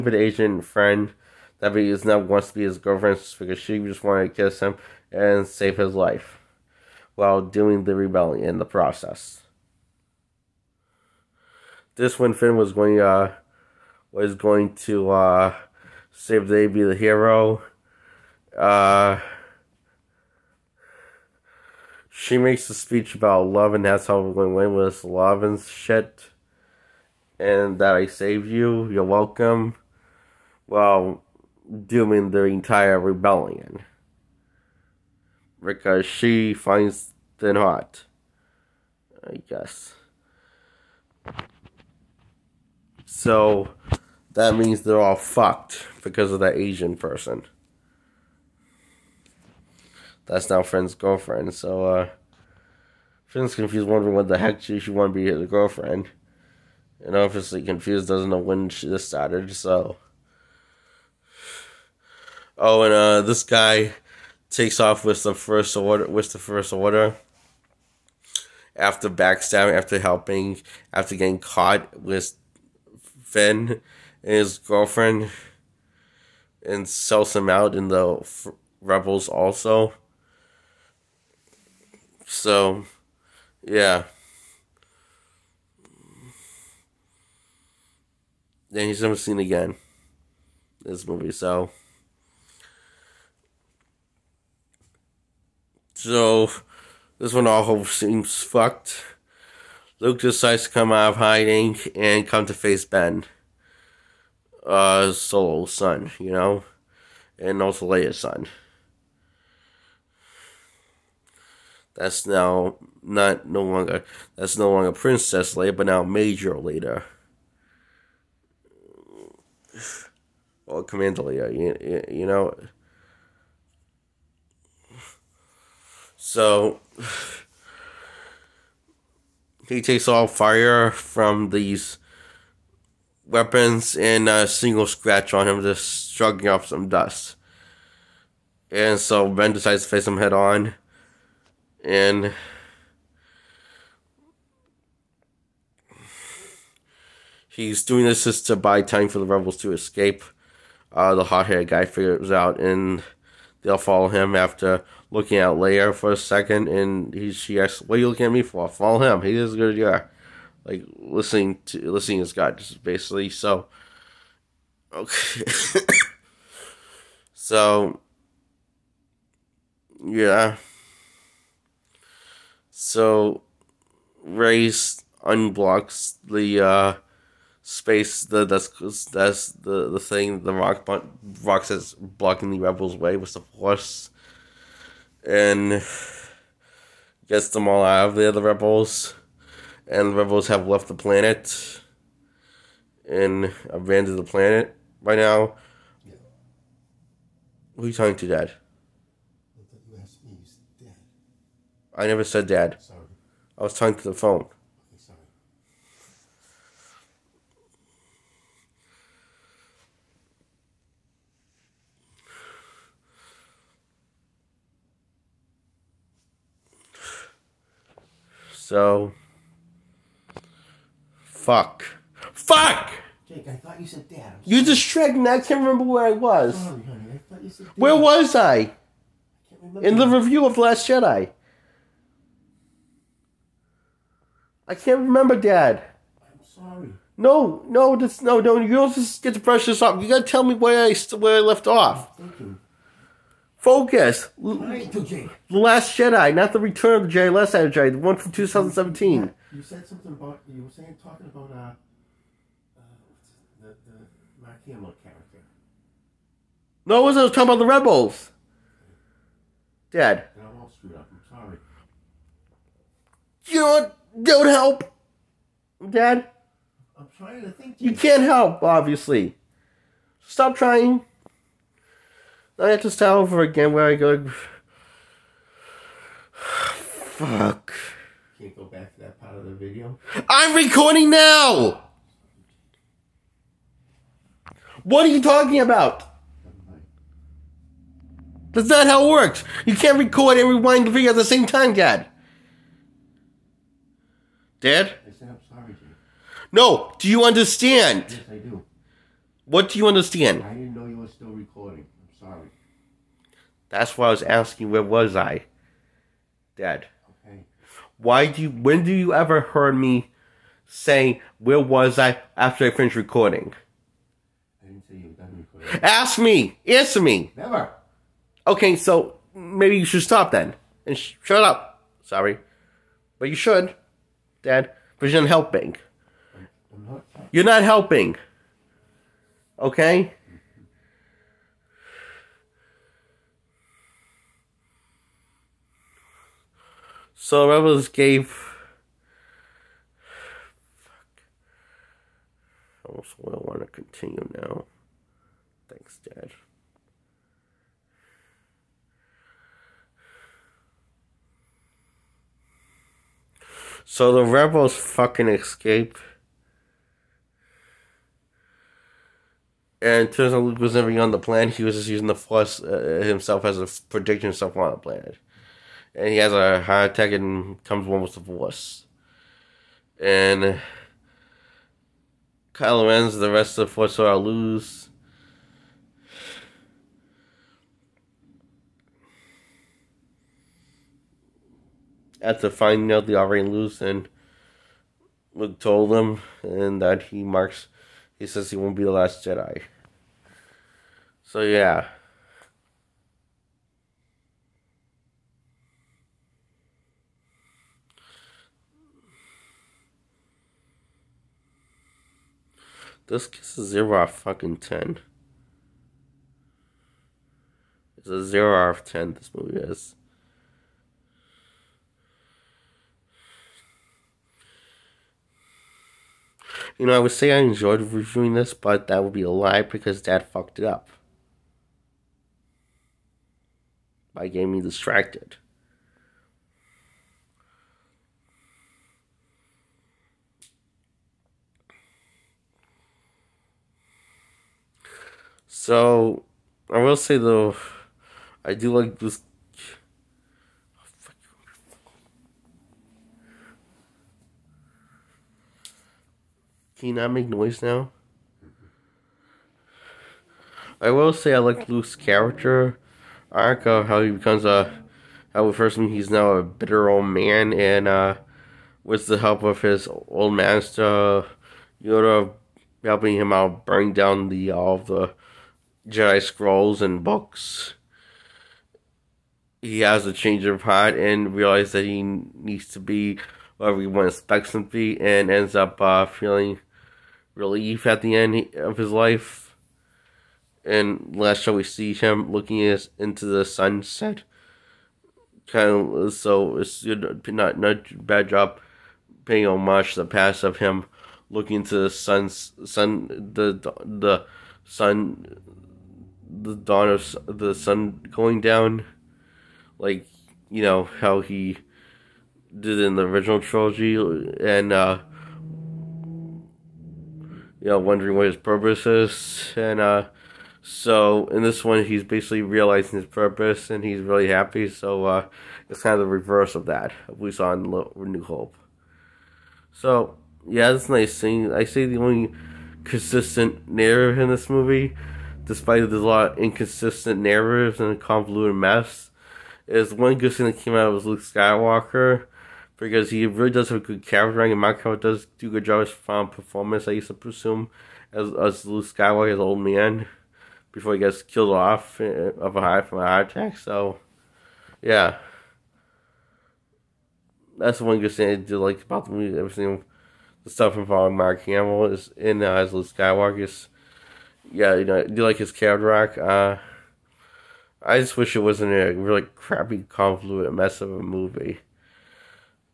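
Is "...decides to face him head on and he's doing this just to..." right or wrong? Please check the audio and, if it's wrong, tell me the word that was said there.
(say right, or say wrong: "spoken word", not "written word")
right.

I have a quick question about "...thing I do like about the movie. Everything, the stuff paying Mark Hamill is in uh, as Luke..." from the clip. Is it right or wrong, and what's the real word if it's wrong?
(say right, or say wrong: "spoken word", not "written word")
wrong: "involving", not "paying".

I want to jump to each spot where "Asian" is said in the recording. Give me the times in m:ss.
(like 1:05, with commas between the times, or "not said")
0:00, 0:46.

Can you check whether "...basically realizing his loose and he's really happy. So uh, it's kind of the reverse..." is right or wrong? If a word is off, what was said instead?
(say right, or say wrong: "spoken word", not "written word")
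wrong: "purpose", not "loose".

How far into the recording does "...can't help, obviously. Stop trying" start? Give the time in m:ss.
4:27.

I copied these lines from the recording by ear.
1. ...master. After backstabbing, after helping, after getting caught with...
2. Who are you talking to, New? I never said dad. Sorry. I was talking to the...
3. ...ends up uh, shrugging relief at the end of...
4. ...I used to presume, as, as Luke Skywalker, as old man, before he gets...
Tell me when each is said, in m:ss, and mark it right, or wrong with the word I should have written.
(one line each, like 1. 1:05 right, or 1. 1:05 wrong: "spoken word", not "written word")
1. 1:06 wrong: "order", not "master"
2. 3:17 wrong: "Dad", not "New"
3. 7:55 wrong: "feeling", not "shrugging"
4. 8:56 right.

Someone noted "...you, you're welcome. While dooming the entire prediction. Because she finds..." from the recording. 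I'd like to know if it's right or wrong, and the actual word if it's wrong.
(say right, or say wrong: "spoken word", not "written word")
wrong: "rebellion", not "prediction".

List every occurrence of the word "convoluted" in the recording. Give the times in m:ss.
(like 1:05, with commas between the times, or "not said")
8:47, 9:19.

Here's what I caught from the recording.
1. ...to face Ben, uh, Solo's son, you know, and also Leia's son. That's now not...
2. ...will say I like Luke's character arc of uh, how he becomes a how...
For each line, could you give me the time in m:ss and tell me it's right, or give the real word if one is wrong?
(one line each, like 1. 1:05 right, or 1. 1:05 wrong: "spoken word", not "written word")
1. 1:42 right
2. 7:30 right.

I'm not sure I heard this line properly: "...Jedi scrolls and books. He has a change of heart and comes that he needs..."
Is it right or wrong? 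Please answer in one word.
wrong.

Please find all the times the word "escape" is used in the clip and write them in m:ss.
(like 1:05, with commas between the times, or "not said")
2:29, 5:55.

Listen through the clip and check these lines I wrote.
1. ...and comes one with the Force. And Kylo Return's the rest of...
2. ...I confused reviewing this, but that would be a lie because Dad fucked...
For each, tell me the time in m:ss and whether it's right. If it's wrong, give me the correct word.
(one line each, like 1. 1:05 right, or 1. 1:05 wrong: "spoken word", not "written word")
1. 6:07 wrong: "Ren", not "Return"
2. 6:57 wrong: "enjoyed", not "confused".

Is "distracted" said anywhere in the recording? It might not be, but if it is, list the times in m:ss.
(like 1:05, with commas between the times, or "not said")
3:44, 7:04.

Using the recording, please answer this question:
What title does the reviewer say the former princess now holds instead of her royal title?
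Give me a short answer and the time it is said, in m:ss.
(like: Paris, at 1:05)
Commander, at 2:00.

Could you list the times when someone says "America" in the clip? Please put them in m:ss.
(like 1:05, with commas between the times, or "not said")
not said.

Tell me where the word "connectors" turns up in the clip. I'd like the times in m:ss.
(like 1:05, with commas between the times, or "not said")
not said.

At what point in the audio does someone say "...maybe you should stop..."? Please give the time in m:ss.
5:19.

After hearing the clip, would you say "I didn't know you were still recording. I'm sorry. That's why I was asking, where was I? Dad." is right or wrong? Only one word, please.
right.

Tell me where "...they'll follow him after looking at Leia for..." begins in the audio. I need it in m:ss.
2:33.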